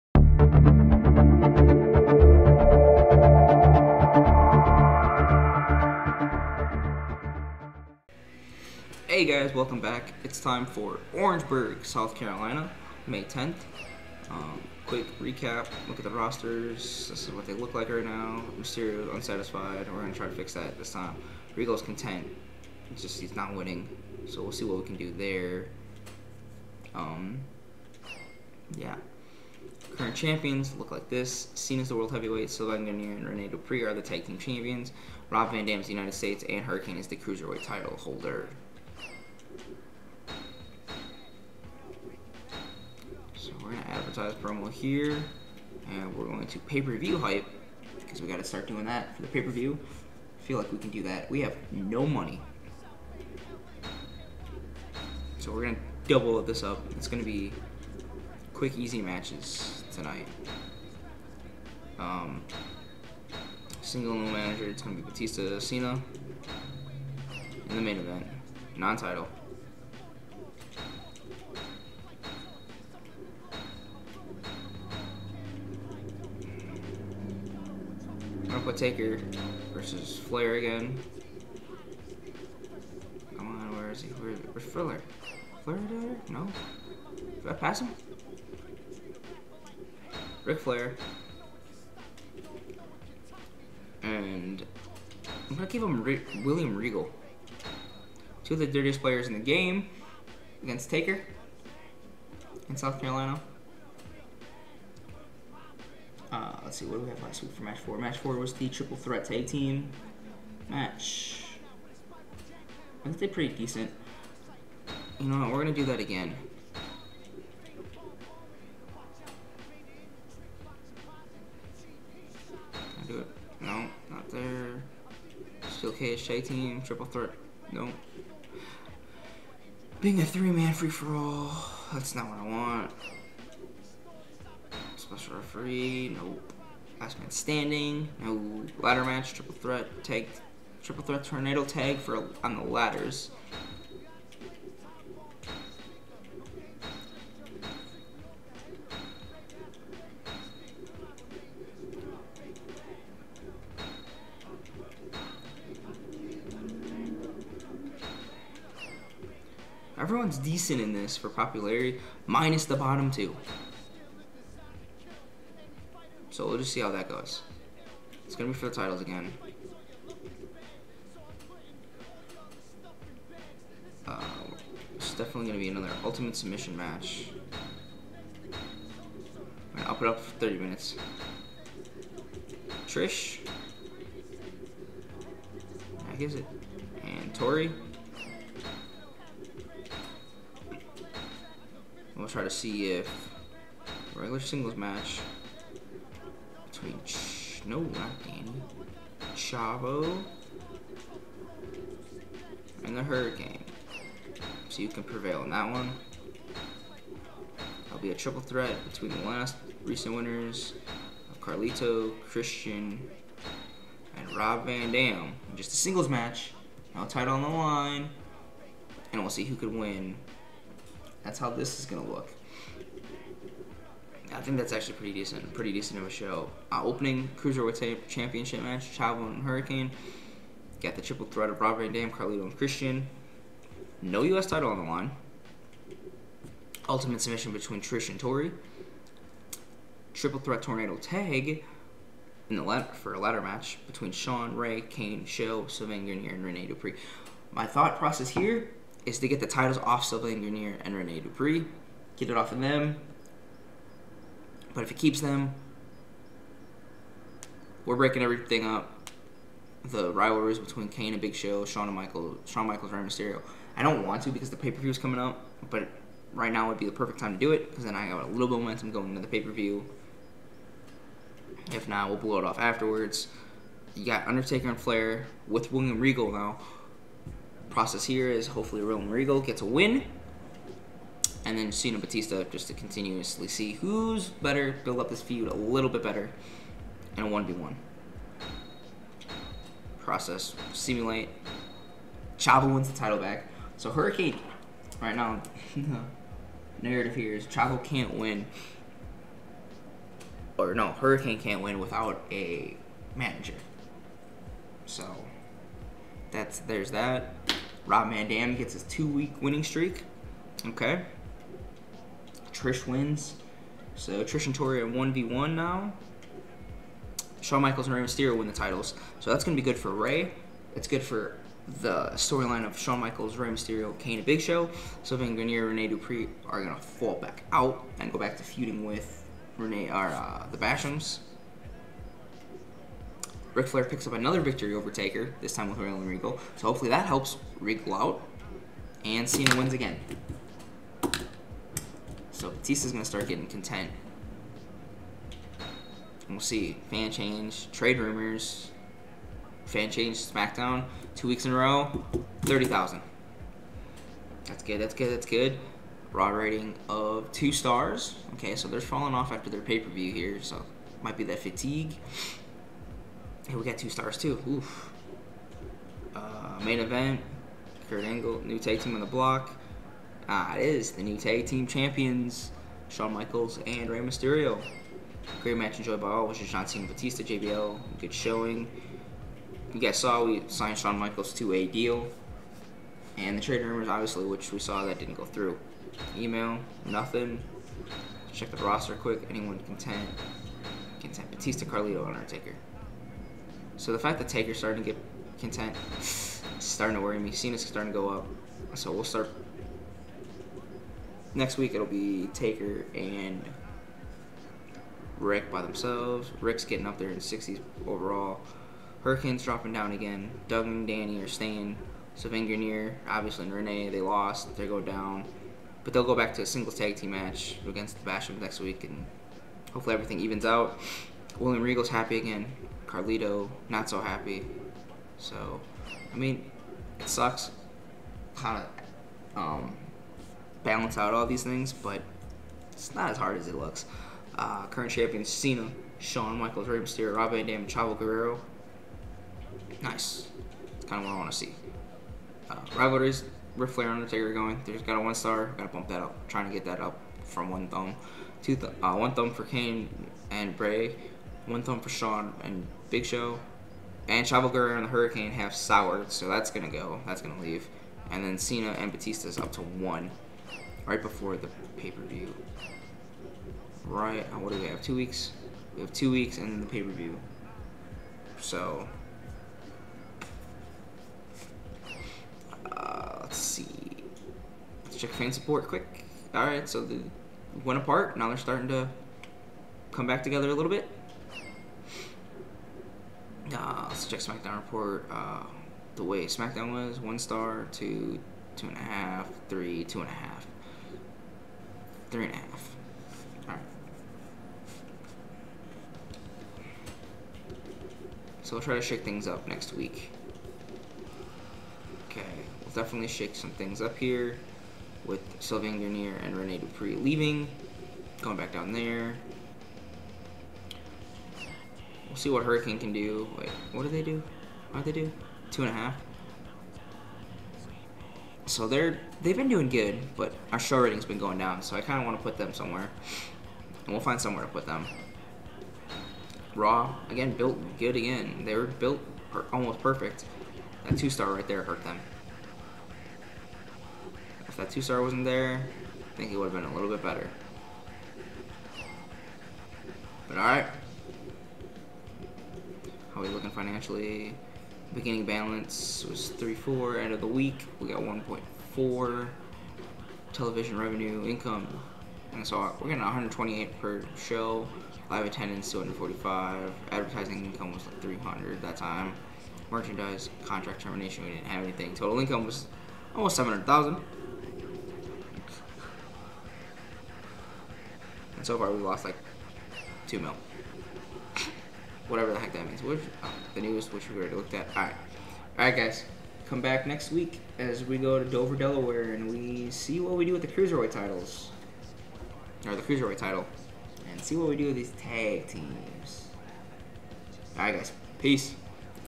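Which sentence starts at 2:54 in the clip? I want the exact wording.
Uh, it's definitely gonna be another ultimate submission match.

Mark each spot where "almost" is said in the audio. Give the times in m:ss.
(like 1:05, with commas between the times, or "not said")
8:49, 9:23.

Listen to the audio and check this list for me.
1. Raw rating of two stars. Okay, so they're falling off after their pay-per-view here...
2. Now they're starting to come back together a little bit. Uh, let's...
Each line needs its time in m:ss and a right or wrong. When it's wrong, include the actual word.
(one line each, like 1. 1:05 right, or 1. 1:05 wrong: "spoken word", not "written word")
1. 5:56 right
2. 7:58 right.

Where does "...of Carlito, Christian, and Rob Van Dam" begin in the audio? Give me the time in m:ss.
3:31.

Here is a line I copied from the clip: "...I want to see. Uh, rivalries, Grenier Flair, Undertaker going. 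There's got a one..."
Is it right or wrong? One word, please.
wrong.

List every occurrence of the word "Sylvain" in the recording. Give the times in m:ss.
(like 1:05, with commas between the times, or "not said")
0:32, 4:05, 4:10, 5:25, 6:52, 8:25.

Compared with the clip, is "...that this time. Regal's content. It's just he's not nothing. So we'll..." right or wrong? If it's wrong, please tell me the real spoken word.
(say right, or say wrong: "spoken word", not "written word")
wrong: "winning", not "nothing".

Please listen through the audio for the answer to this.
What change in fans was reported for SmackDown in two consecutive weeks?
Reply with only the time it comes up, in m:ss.
5:52.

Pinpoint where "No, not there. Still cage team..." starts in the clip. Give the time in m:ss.
2:03.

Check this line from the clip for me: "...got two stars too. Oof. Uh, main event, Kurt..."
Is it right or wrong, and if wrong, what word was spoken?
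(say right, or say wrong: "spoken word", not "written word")
right.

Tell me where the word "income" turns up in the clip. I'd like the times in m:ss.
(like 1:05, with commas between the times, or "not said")
9:11, 9:17, 9:22.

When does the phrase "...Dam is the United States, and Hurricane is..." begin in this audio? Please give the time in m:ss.
0:35.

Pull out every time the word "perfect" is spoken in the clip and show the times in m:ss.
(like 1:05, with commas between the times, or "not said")
4:26, 8:49.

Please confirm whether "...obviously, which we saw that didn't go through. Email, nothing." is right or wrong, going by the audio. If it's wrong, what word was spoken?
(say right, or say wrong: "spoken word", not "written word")
right.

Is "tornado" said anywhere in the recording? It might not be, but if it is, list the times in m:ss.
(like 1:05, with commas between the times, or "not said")
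2:21, 4:00.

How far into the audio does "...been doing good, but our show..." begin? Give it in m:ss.
8:39.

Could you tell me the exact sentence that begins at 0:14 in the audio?
Um, quick recap, look at the rosters.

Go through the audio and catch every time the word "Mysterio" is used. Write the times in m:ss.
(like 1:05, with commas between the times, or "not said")
0:18, 4:22, 5:18, 5:23, 6:13, 7:16.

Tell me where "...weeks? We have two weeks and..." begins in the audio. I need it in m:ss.
7:44.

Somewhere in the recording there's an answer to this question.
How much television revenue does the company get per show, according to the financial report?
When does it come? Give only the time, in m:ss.
9:13.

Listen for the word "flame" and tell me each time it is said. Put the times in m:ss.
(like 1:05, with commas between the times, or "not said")
not said.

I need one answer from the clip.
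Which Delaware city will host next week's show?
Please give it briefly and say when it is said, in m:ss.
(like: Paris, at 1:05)
Dover, at 9:38.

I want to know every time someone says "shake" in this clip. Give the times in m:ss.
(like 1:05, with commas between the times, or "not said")
8:18, 8:23.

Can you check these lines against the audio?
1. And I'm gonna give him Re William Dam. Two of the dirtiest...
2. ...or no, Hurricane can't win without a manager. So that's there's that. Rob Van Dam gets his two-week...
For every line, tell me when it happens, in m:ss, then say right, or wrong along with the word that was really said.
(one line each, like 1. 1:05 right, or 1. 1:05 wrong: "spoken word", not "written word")
1. 1:34 wrong: "Regal", not "Dam"
2. 5:00 right.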